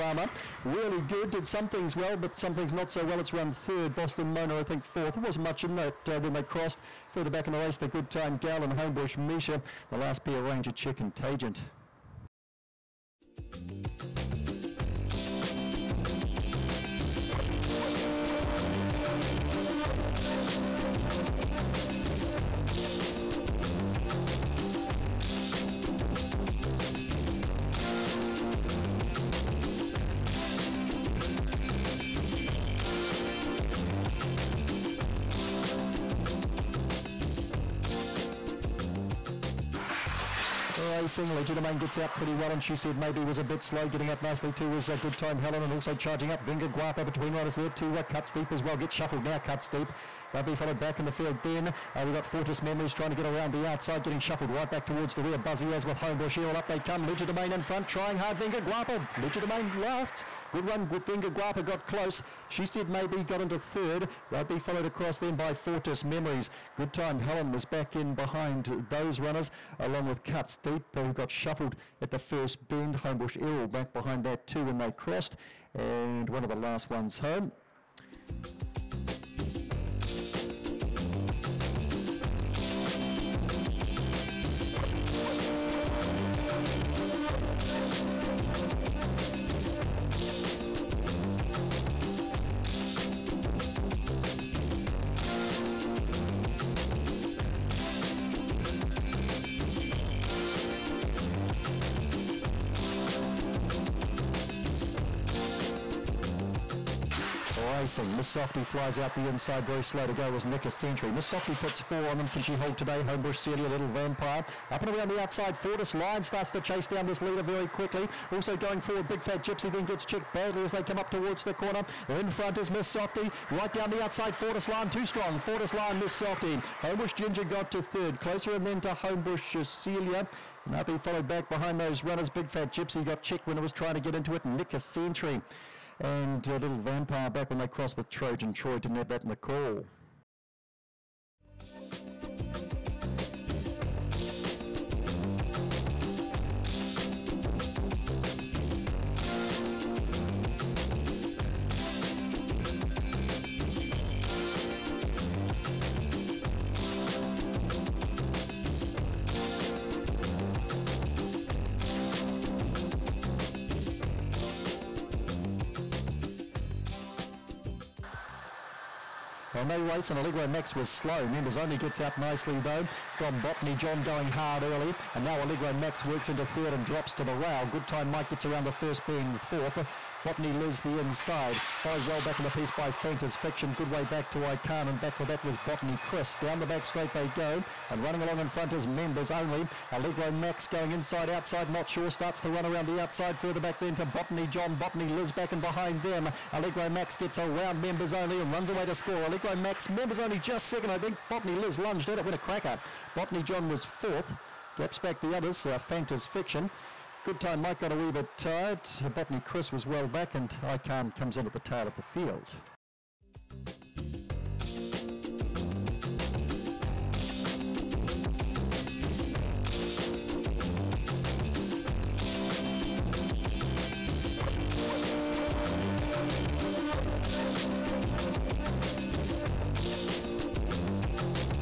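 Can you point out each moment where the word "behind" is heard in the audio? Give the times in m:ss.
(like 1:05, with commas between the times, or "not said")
1:08, 1:13, 2:11, 3:15.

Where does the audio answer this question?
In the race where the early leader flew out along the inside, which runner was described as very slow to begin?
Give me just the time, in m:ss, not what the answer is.
1:50.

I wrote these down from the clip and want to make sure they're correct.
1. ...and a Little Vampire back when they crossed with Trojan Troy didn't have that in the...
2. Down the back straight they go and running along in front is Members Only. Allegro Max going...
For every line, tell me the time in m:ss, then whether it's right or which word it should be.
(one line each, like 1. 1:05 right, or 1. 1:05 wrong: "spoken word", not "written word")
1. 2:15 right
2. 3:06 right.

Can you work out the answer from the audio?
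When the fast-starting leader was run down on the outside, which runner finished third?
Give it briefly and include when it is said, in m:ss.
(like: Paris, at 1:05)
Homebush Ginger, at 2:06.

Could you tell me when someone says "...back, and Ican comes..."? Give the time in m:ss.
3:30.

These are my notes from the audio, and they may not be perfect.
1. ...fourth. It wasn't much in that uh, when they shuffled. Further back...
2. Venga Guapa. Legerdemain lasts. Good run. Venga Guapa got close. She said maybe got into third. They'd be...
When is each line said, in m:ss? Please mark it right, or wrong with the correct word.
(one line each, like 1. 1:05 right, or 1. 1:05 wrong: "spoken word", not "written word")
1. 0:04 wrong: "crossed", not "shuffled"
2. 0:58 right.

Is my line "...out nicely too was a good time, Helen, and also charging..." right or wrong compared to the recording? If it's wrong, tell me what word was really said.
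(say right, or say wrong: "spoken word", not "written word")
right.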